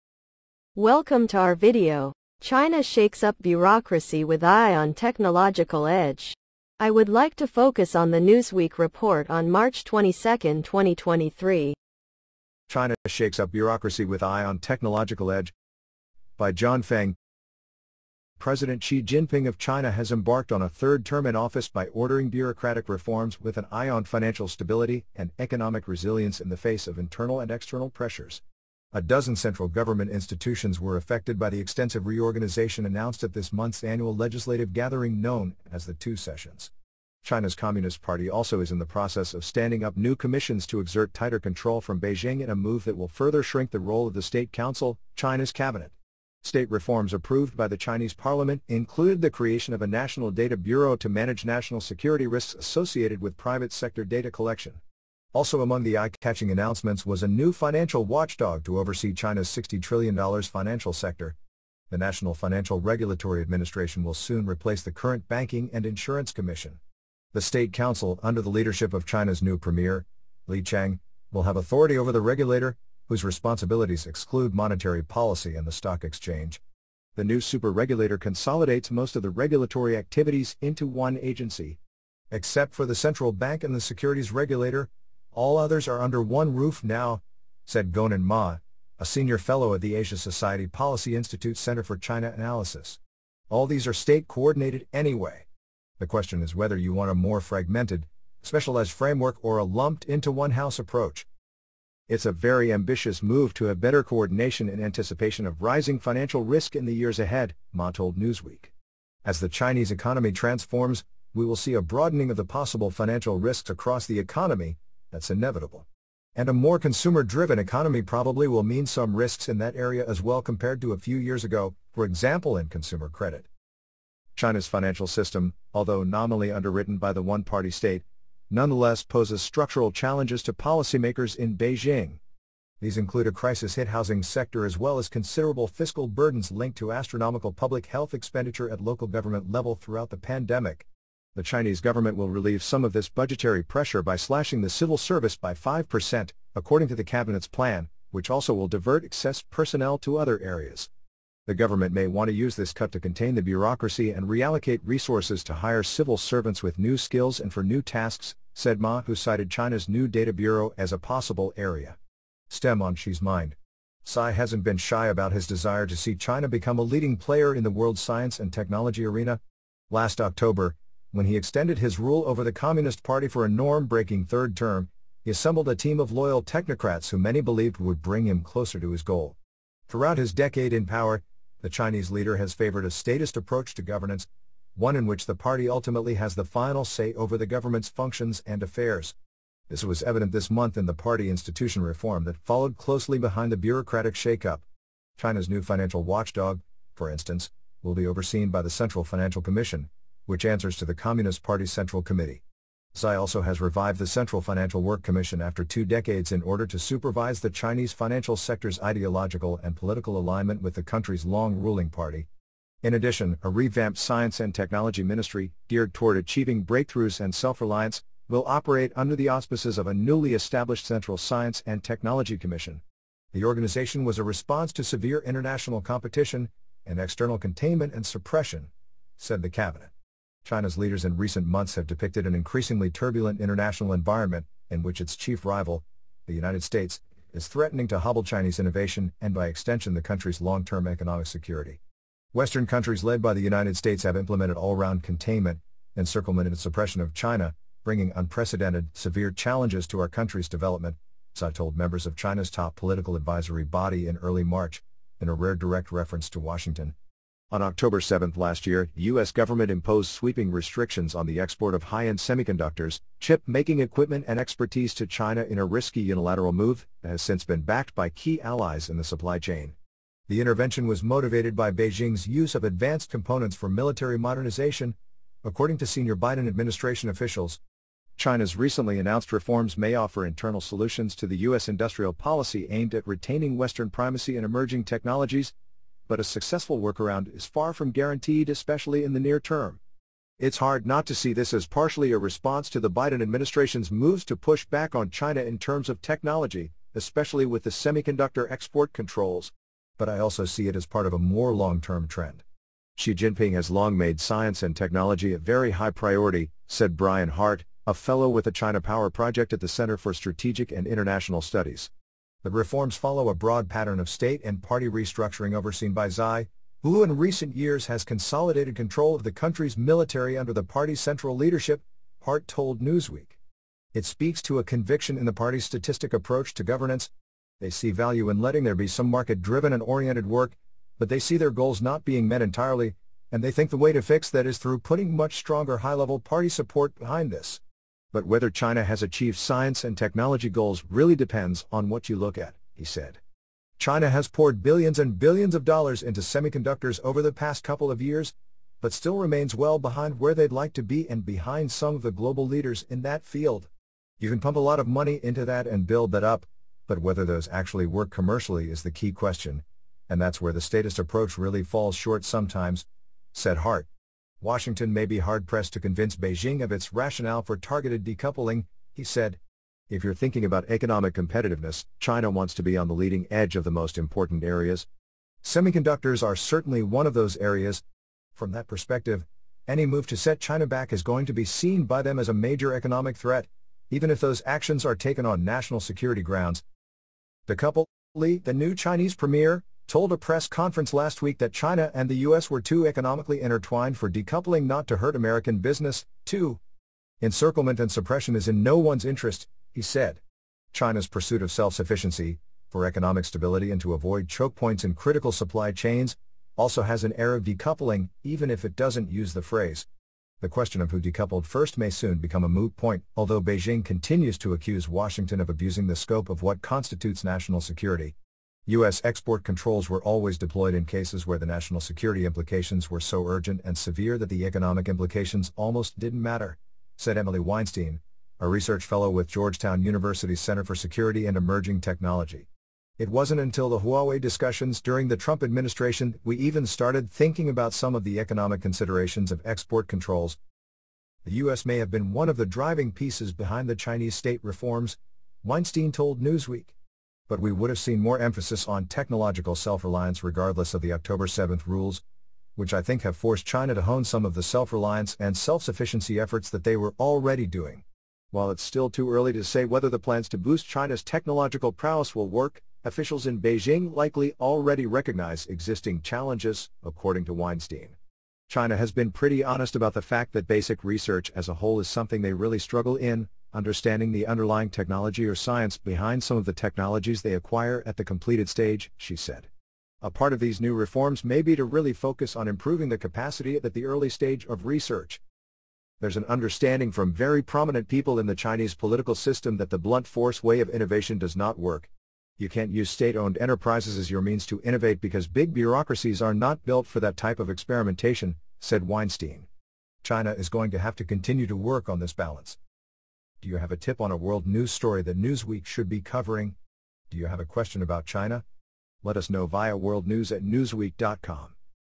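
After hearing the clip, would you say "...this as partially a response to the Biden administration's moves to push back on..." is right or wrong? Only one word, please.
right.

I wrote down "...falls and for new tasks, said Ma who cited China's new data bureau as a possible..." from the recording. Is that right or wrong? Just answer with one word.
wrong.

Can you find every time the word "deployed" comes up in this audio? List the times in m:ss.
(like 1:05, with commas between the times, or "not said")
7:00.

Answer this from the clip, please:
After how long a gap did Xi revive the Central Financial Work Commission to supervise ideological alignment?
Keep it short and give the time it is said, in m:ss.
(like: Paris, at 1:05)
2 decades, at 3:25.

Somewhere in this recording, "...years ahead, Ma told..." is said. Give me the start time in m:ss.
1:46.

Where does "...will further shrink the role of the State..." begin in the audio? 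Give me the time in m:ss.
0:42.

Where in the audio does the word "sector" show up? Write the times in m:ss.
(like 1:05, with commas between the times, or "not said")
0:53, 1:00, 2:14, 3:28.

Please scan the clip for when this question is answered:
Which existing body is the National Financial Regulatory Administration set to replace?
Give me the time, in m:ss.
1:05.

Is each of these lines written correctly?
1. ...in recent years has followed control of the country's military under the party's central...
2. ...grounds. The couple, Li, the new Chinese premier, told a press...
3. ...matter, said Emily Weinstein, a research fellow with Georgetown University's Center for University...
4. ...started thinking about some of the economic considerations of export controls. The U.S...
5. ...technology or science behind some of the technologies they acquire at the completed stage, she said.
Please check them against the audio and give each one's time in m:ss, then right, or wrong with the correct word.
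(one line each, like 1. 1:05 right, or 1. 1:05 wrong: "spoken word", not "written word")
1. 5:17 wrong: "consolidated", not "followed"
2. 6:26 right
3. 7:06 wrong: "Security", not "University"
4. 7:16 right
5. 7:54 right.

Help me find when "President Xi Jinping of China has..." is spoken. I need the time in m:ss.
0:18.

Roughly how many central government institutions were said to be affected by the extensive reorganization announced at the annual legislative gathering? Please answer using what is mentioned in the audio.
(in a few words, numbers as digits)
12.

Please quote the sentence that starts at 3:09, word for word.
This was evident this month in the party institution reform that followed closely behind the bureaucratic shakeup.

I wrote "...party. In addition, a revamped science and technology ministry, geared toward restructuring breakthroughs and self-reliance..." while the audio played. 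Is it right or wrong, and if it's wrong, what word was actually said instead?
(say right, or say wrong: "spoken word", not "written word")
wrong: "achieving", not "restructuring".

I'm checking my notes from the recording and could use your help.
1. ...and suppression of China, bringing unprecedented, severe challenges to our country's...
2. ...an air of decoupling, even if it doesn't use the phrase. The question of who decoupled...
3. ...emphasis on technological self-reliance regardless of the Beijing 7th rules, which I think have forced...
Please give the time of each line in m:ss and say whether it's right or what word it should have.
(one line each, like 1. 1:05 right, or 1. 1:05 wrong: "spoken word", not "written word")
1. 4:06 right
2. 6:47 right
3. 7:28 wrong: "October", not "Beijing".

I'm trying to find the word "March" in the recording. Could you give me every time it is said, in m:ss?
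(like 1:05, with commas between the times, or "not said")
0:09, 4:14.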